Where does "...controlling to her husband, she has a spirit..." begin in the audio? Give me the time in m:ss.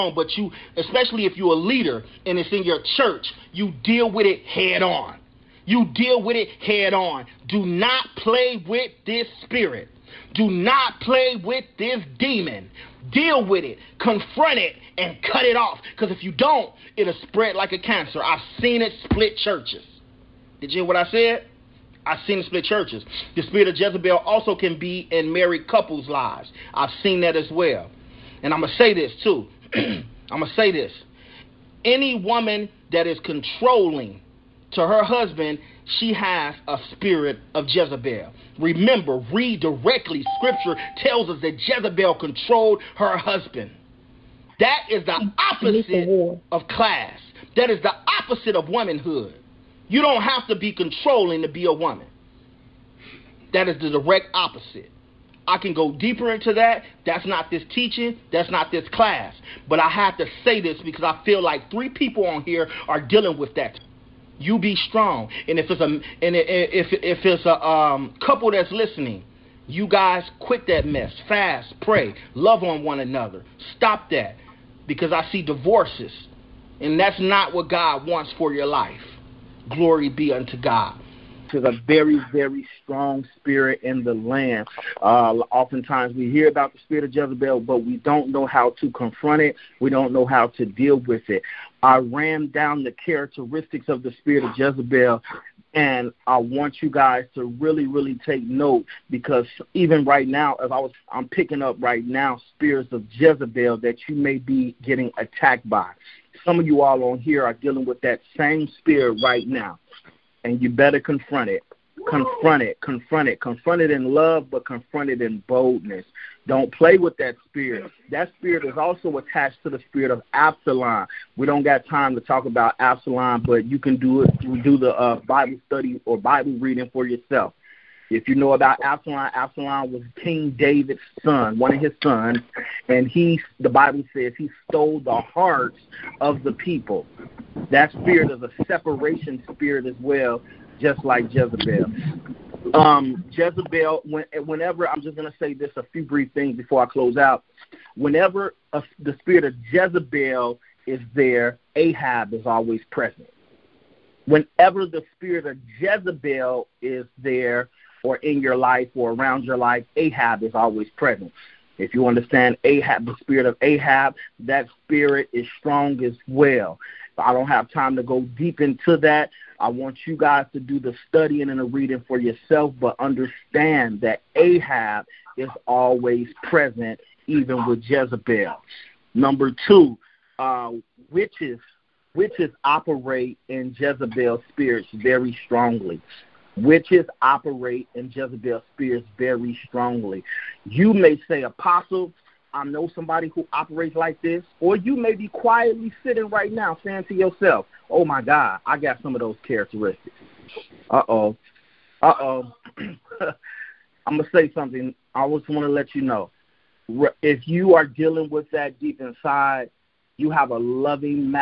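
0:33.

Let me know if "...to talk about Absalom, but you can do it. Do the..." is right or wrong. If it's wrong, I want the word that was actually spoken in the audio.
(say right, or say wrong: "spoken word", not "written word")
right.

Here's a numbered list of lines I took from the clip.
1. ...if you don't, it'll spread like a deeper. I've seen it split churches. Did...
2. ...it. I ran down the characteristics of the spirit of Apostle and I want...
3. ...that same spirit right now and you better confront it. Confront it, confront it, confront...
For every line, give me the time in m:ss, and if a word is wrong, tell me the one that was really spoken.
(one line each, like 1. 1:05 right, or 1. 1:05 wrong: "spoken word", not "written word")
1. 0:16 wrong: "cancer", not "deeper"
2. 1:31 wrong: "Jezebel", not "Apostle"
3. 1:48 right.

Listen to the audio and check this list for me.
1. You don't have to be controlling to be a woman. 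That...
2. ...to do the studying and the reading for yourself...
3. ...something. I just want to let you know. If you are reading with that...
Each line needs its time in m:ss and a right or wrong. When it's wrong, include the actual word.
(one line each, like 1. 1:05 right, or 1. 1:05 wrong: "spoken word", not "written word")
1. 0:49 right
2. 2:50 right
3. 3:24 wrong: "dealing", not "reading".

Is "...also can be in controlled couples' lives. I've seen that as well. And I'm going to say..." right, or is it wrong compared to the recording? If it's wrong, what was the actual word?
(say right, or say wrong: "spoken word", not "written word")
wrong: "married", not "controlled".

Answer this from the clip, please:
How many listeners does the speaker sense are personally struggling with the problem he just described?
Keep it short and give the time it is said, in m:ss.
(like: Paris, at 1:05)
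3, at 1:01.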